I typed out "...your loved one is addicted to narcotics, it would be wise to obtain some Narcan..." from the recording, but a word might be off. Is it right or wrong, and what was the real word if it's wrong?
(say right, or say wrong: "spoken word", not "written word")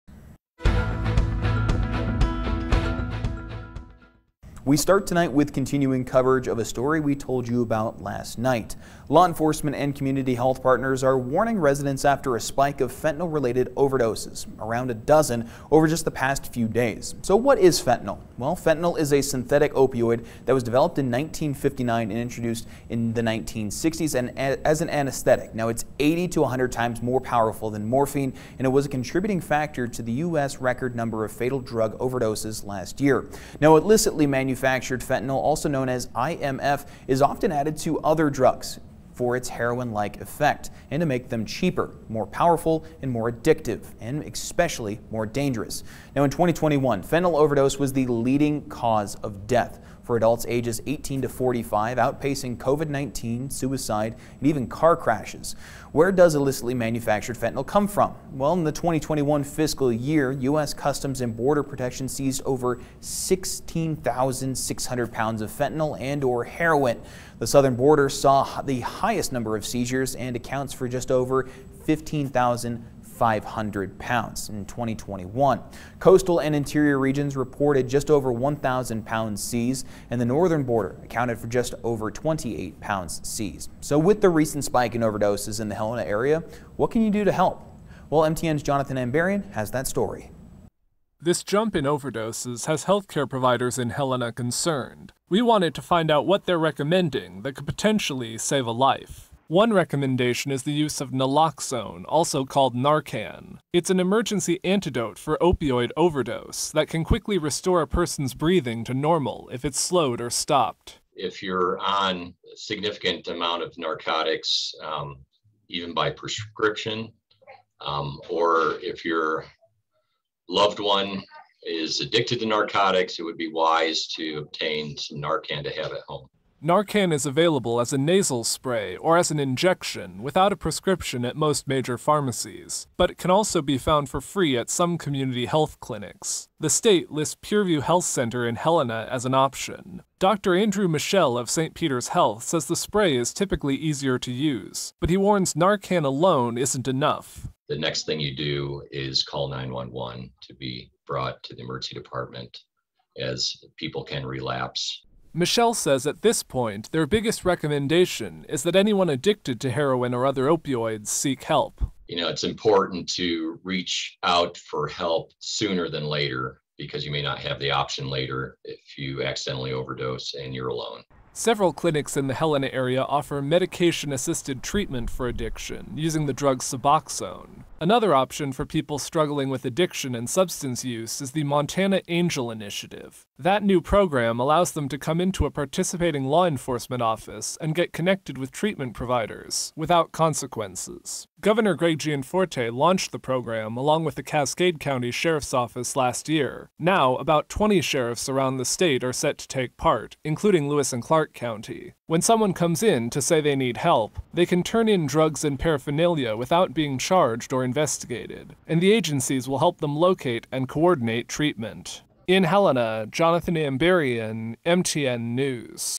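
right.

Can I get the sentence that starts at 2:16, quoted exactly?
The state lists Pureview Health Center in Helena as an option.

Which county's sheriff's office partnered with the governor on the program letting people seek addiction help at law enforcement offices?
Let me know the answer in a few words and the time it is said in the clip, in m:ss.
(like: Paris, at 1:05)
Cascade County, at 3:14.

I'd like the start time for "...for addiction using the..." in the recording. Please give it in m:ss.
2:55.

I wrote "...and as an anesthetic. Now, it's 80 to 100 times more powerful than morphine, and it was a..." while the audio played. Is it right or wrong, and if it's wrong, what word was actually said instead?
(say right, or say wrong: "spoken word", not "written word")
right.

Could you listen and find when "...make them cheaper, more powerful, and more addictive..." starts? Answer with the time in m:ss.
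0:41.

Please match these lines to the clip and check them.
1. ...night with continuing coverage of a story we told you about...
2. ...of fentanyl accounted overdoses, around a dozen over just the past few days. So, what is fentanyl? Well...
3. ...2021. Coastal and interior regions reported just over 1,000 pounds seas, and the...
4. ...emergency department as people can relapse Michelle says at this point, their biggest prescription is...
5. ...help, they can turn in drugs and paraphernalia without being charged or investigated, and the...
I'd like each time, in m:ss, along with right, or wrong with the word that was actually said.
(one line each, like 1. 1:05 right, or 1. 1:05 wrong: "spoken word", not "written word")
1. 0:05 wrong: "tonight", not "night"
2. 0:12 wrong: "related", not "accounted"
3. 1:14 right
4. 2:31 wrong: "recommendation", not "prescription"
5. 3:23 right.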